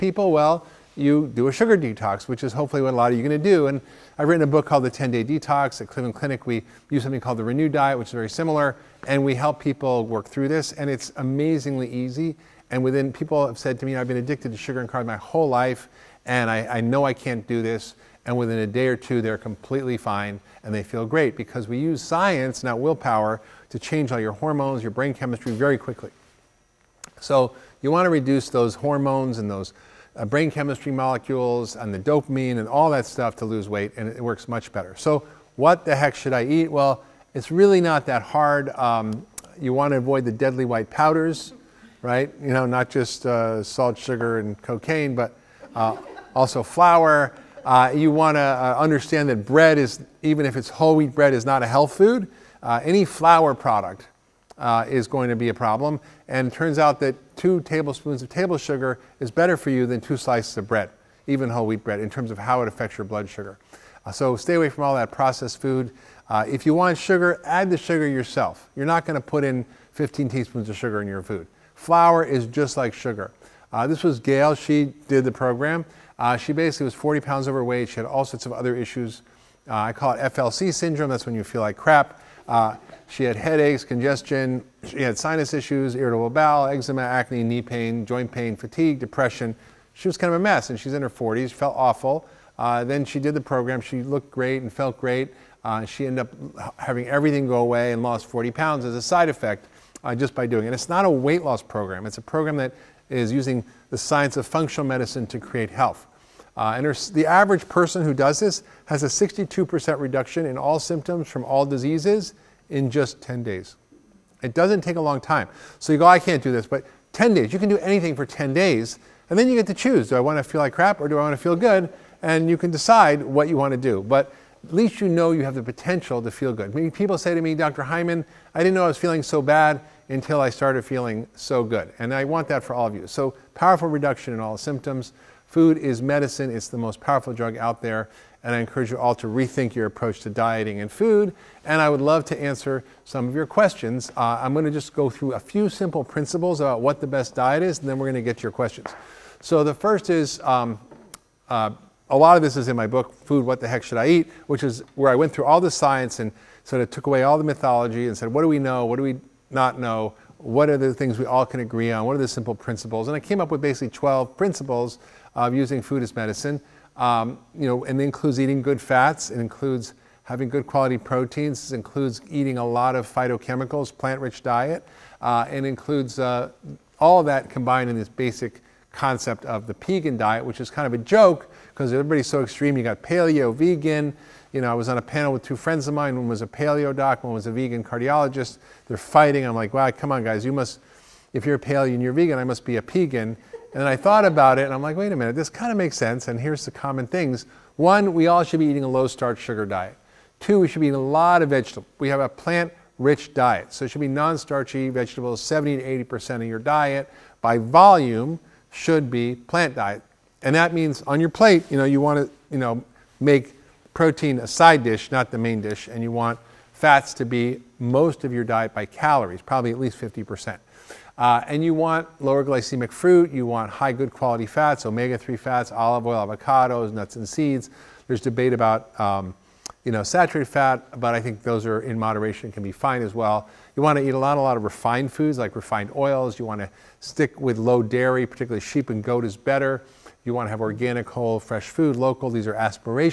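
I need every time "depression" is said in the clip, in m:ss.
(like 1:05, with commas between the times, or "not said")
1:28.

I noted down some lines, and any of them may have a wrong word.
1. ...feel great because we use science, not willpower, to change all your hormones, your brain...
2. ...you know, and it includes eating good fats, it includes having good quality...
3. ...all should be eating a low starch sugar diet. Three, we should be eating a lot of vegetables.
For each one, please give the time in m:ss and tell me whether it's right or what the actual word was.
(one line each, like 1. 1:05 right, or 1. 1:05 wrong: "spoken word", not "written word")
1. 0:20 right
2. 2:47 right
3. 3:18 wrong: "Two", not "Three".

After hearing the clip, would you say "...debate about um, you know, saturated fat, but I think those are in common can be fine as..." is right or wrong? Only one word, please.
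wrong.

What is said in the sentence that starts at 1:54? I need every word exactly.
It doesn't take a long time.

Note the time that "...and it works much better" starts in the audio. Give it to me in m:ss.
0:33.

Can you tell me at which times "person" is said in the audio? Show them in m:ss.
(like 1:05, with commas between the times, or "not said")
1:47.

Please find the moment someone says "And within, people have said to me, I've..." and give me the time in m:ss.
0:12.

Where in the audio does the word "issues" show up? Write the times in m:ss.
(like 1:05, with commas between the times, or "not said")
1:18, 1:25.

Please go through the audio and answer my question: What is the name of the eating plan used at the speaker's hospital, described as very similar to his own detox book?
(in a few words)
Renew Diet.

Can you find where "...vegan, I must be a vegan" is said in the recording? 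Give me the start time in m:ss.
3:12.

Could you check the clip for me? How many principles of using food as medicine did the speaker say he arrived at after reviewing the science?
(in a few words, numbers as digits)
12.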